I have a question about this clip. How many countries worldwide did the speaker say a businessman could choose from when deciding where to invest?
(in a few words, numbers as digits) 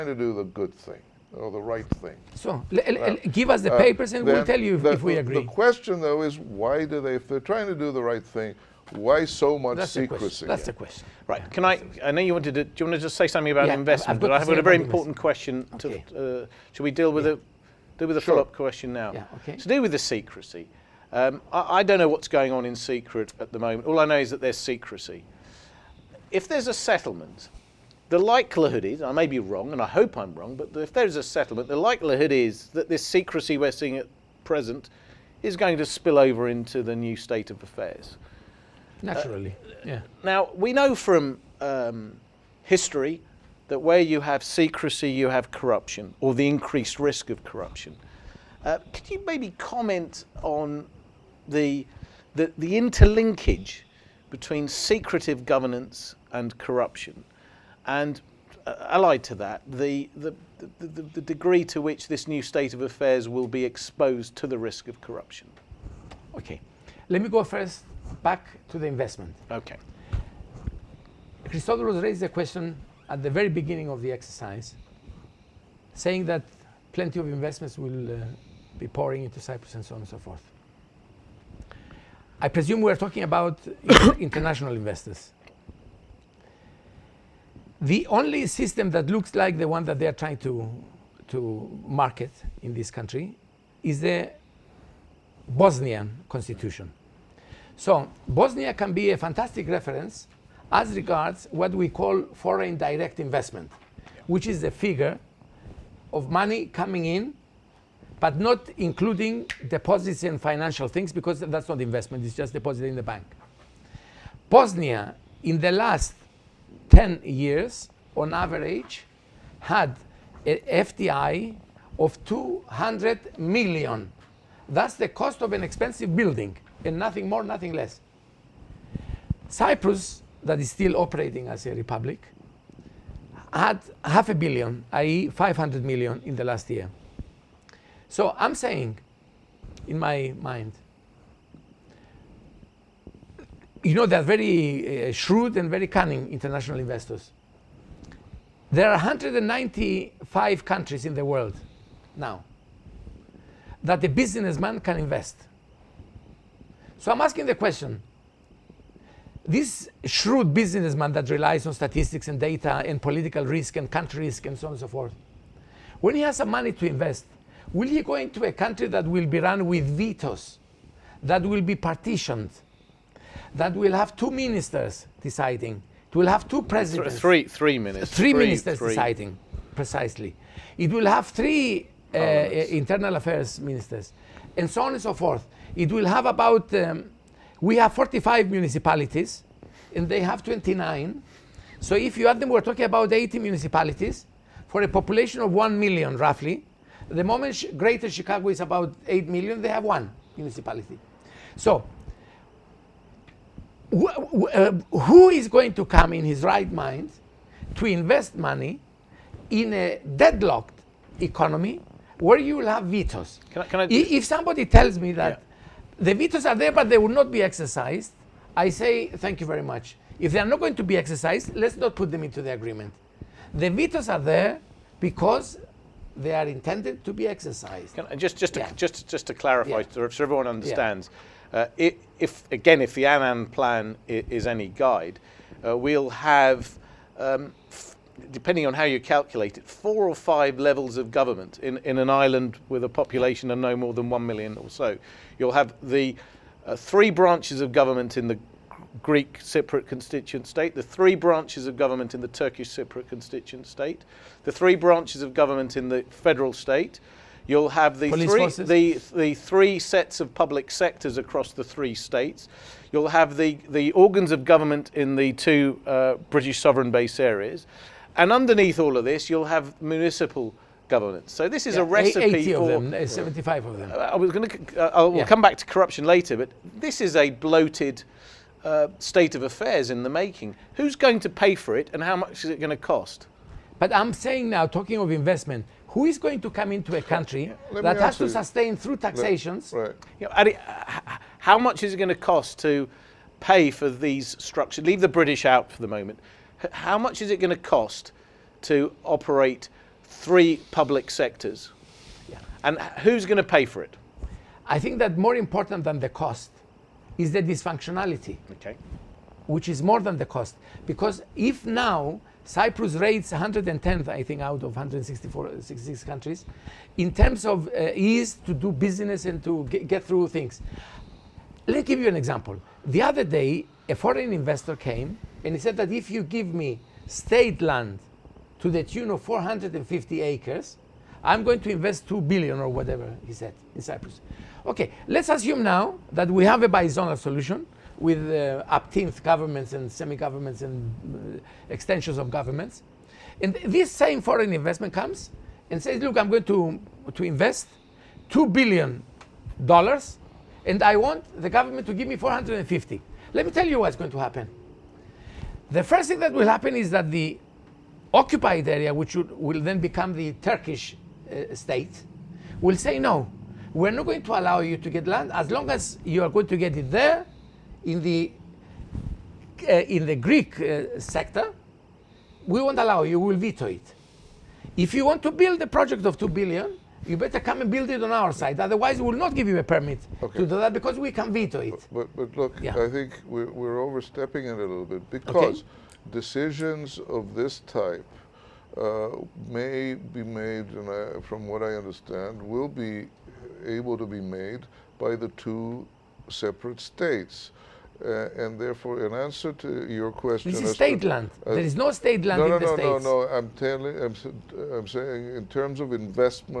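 195.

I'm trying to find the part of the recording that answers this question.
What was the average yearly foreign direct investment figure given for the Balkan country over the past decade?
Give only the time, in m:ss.
2:00.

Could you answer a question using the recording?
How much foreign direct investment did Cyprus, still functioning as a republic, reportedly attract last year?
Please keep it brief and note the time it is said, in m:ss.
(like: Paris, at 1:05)
500 million, at 2:15.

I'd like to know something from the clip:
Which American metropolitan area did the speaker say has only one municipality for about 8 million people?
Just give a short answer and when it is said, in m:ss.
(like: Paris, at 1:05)
Greater Chicago, at 3:17.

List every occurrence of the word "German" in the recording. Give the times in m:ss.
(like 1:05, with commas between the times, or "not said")
not said.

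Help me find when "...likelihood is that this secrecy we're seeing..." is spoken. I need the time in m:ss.
0:31.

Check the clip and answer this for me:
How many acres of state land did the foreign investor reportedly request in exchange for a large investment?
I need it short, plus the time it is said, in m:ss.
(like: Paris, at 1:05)
450 acres, at 5:29.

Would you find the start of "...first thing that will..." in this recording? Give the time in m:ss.
5:55.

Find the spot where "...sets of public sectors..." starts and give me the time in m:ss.
4:19.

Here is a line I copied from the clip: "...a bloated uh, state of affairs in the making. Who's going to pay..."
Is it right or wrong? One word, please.
right.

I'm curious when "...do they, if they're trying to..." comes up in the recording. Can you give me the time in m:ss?
0:06.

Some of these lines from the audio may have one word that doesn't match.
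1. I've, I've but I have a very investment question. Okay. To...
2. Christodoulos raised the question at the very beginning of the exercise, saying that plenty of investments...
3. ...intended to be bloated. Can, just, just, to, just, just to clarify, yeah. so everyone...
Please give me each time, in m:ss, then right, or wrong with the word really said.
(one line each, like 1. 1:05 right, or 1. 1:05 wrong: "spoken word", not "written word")
1. 0:14 wrong: "important", not "investment"
2. 1:11 right
3. 3:46 wrong: "exercised", not "bloated".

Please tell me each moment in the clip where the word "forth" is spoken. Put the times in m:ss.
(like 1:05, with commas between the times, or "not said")
1:20, 2:44, 3:05.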